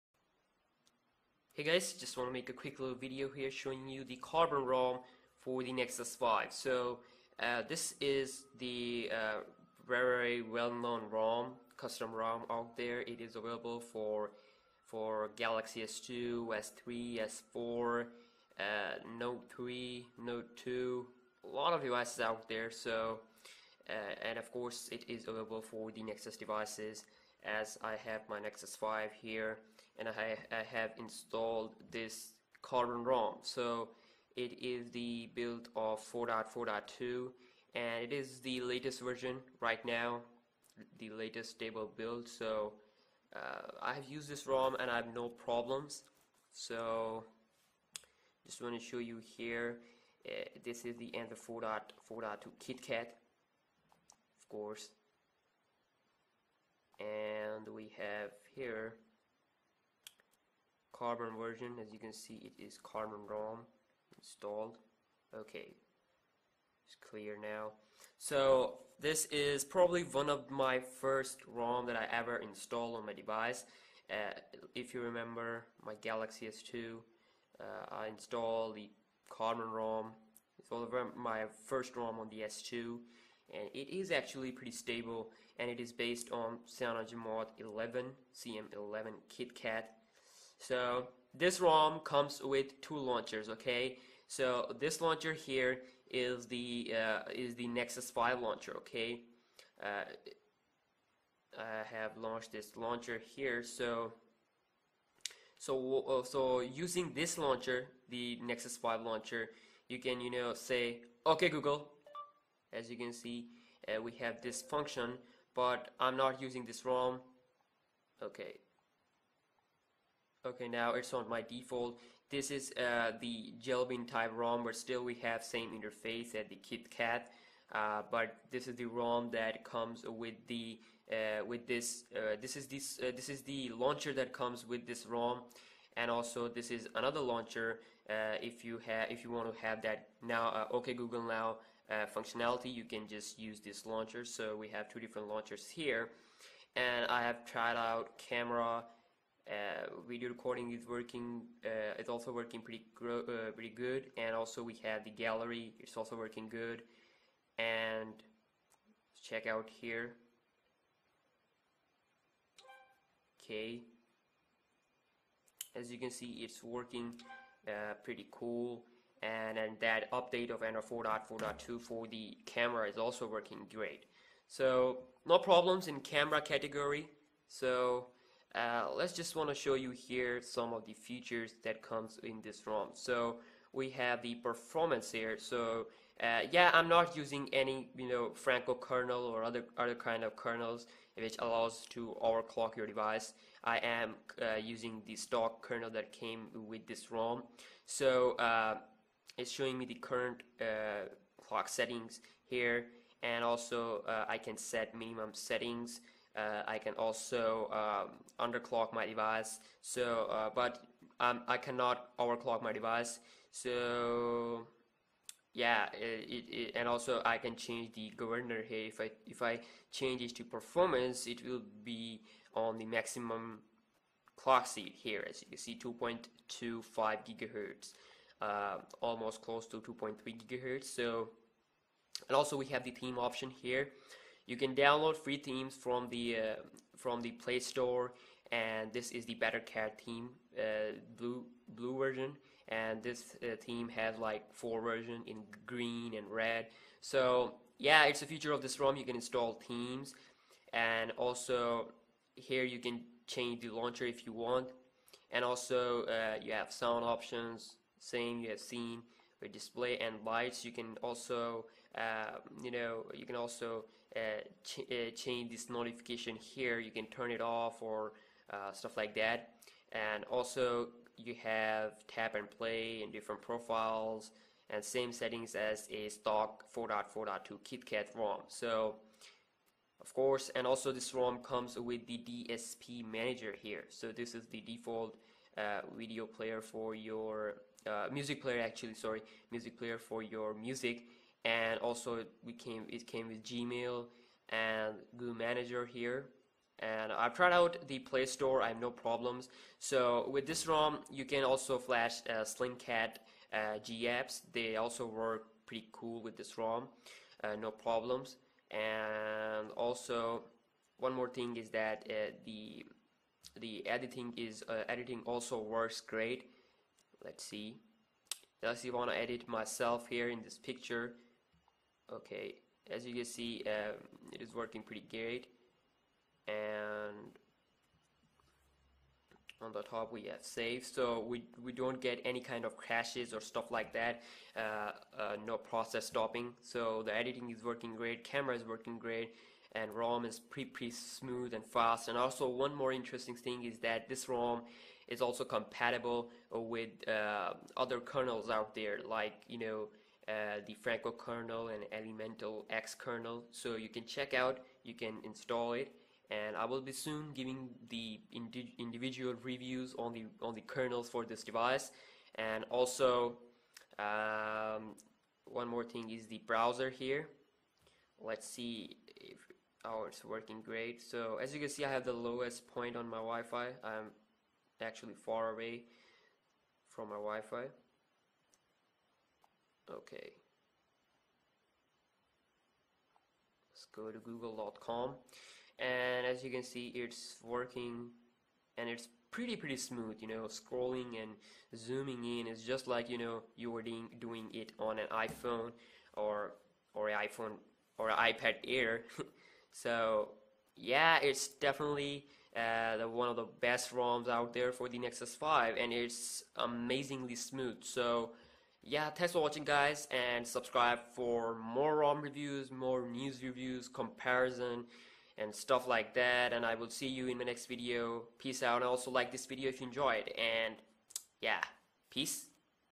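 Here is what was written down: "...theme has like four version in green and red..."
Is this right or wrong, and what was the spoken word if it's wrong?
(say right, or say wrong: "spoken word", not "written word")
right.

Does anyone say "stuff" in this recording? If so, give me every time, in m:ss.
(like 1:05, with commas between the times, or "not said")
4:28, 5:33, 6:55.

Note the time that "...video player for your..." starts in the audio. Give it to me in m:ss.
4:45.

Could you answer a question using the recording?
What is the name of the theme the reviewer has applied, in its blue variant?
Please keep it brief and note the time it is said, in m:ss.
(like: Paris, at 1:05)
Better Cat, at 3:59.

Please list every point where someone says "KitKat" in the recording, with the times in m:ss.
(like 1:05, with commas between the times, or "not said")
0:52, 1:29, 2:06, 4:37.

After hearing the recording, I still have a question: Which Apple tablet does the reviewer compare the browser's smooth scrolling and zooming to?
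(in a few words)
iPad Air.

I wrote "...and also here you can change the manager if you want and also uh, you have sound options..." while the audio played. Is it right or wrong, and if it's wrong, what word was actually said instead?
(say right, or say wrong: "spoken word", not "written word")
wrong: "launcher", not "manager".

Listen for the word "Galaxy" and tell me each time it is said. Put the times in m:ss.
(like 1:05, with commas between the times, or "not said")
0:15, 1:16.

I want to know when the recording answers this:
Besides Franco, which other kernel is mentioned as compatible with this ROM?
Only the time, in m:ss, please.
5:51.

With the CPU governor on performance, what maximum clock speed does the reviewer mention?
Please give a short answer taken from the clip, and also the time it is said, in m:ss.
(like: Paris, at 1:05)
2.25 gigahertz, at 3:45.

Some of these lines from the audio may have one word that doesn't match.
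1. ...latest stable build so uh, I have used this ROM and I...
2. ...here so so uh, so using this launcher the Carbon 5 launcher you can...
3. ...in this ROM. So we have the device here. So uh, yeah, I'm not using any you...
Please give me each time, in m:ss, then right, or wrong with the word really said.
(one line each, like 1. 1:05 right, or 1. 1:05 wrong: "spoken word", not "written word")
1. 0:41 right
2. 1:43 wrong: "Nexus", not "Carbon"
3. 3:02 wrong: "performance", not "device".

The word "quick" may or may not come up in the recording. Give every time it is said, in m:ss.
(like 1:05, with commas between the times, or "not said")
0:02.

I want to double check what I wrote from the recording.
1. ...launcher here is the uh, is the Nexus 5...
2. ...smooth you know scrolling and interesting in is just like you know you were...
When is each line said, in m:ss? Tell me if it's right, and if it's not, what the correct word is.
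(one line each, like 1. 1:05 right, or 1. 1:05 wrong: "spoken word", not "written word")
1. 1:35 right
2. 6:29 wrong: "zooming", not "interesting".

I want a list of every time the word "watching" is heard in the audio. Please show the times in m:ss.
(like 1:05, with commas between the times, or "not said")
6:49.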